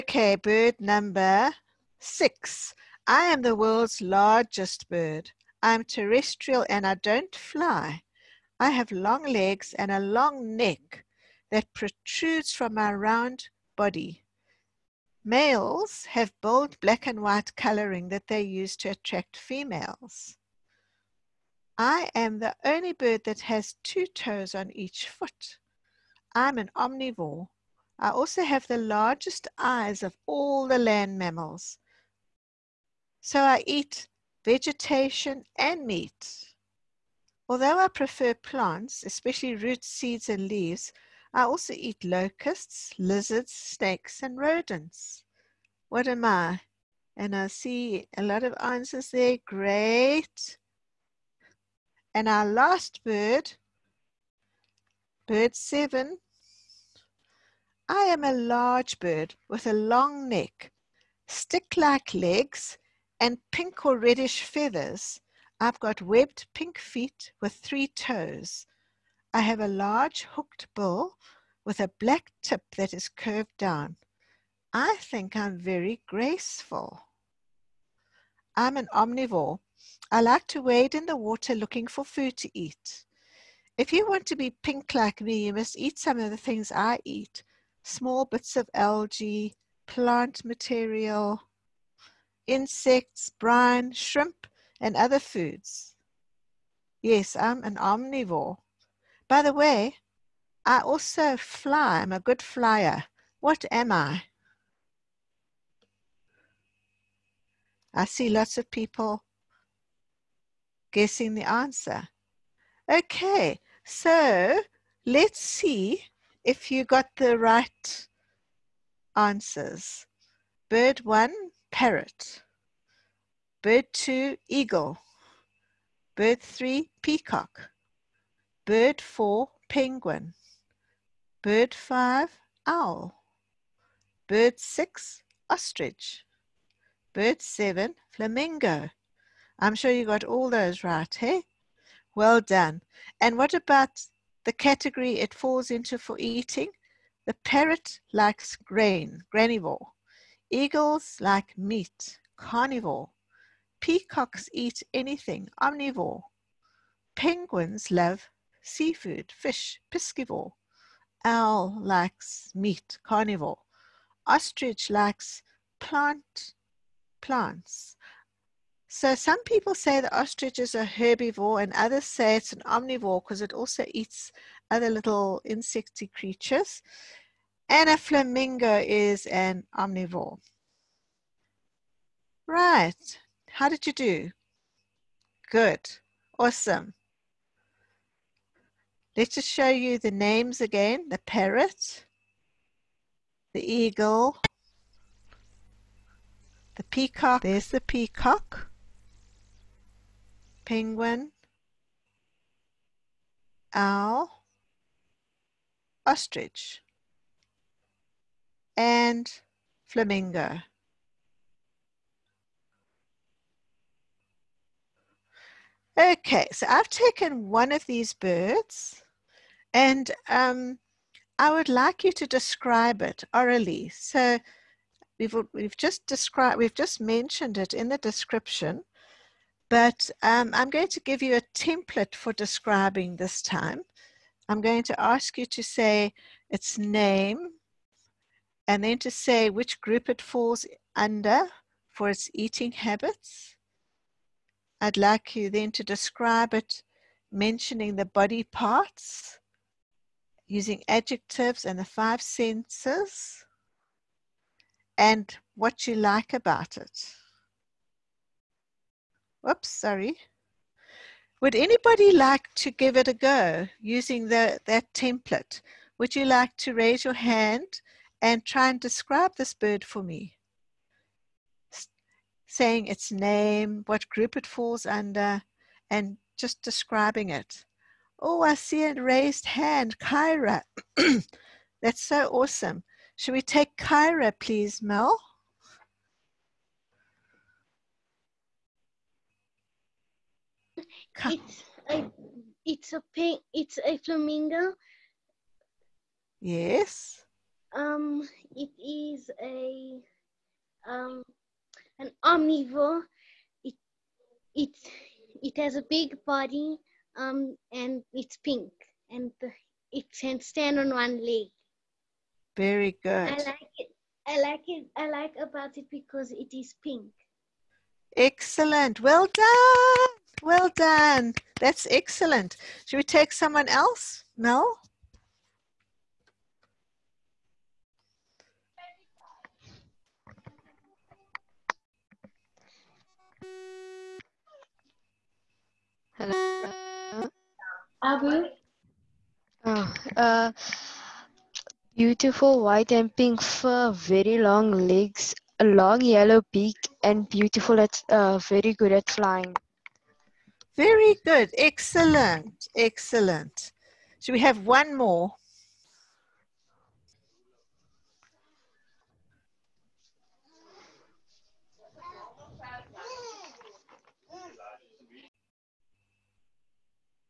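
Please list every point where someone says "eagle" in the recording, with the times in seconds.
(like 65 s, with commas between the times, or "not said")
124 s, 150 s, 193 s.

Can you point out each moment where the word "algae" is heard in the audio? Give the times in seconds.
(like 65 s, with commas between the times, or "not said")
88 s.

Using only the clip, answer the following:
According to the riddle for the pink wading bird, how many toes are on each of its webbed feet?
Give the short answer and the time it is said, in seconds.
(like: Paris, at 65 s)
3, at 67 s.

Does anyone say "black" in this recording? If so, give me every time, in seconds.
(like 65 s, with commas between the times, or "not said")
16 s, 71 s.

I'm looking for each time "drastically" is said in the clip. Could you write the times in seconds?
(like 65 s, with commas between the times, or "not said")
not said.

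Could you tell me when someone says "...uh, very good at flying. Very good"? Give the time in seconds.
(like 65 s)
348 s.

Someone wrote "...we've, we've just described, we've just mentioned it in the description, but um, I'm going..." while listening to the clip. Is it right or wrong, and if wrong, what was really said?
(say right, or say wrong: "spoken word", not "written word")
right.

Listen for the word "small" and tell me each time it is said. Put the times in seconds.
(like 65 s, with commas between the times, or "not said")
87 s.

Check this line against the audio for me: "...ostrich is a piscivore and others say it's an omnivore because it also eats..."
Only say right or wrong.
wrong.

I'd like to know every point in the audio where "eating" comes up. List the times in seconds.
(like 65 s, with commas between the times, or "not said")
146 s, 242 s.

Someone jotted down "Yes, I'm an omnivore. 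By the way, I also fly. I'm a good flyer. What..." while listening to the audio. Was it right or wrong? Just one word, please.
right.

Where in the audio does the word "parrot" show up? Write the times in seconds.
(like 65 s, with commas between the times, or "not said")
121 s, 147 s, 191 s.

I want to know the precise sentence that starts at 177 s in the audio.
And a flamingo is an omnivore.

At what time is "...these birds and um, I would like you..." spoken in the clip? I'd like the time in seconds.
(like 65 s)
217 s.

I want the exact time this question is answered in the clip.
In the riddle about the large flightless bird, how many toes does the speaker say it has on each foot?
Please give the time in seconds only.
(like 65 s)
23 s.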